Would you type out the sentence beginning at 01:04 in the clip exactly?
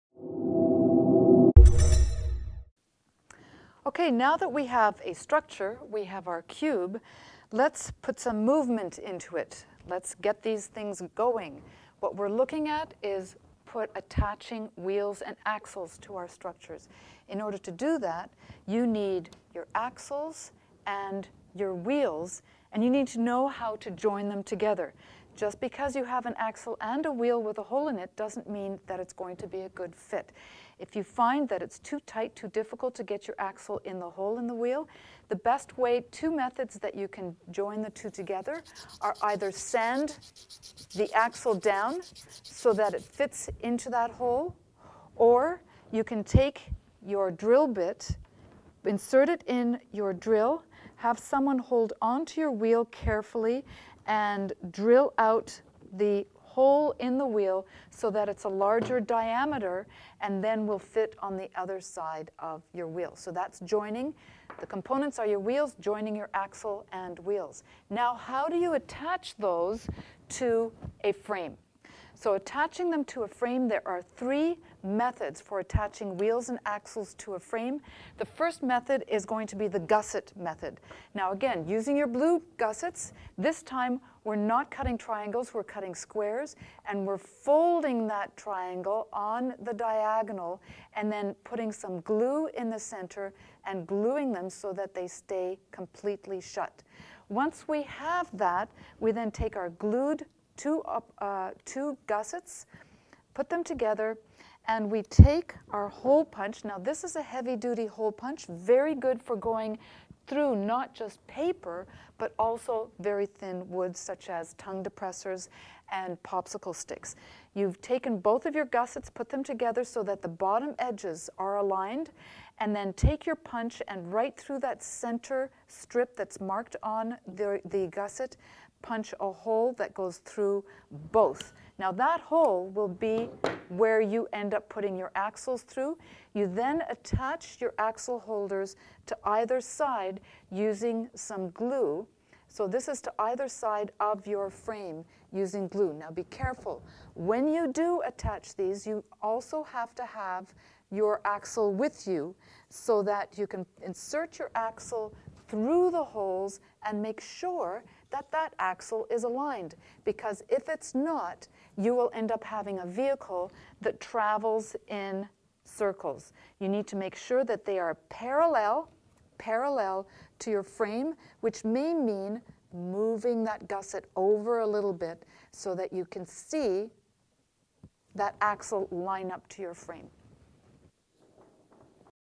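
The components are your wheels, joining your axle and wheels.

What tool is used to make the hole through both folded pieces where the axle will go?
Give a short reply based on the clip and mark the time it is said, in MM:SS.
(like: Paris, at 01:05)
Heavy duty hole punch, at 01:47.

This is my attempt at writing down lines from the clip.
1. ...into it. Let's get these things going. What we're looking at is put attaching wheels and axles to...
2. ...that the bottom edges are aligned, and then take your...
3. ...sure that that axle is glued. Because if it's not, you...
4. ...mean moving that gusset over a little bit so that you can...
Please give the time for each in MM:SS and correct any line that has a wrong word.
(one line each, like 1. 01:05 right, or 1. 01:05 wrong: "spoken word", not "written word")
1. 00:08 right
2. 02:00 right
3. 02:37 wrong: "aligned", not "glued"
4. 02:51 right.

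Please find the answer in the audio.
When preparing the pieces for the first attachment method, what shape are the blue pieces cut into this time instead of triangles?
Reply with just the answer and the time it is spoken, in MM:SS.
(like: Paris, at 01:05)
Squares, at 01:25.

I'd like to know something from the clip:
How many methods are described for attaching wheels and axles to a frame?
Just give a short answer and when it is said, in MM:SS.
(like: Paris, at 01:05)
3, at 01:14.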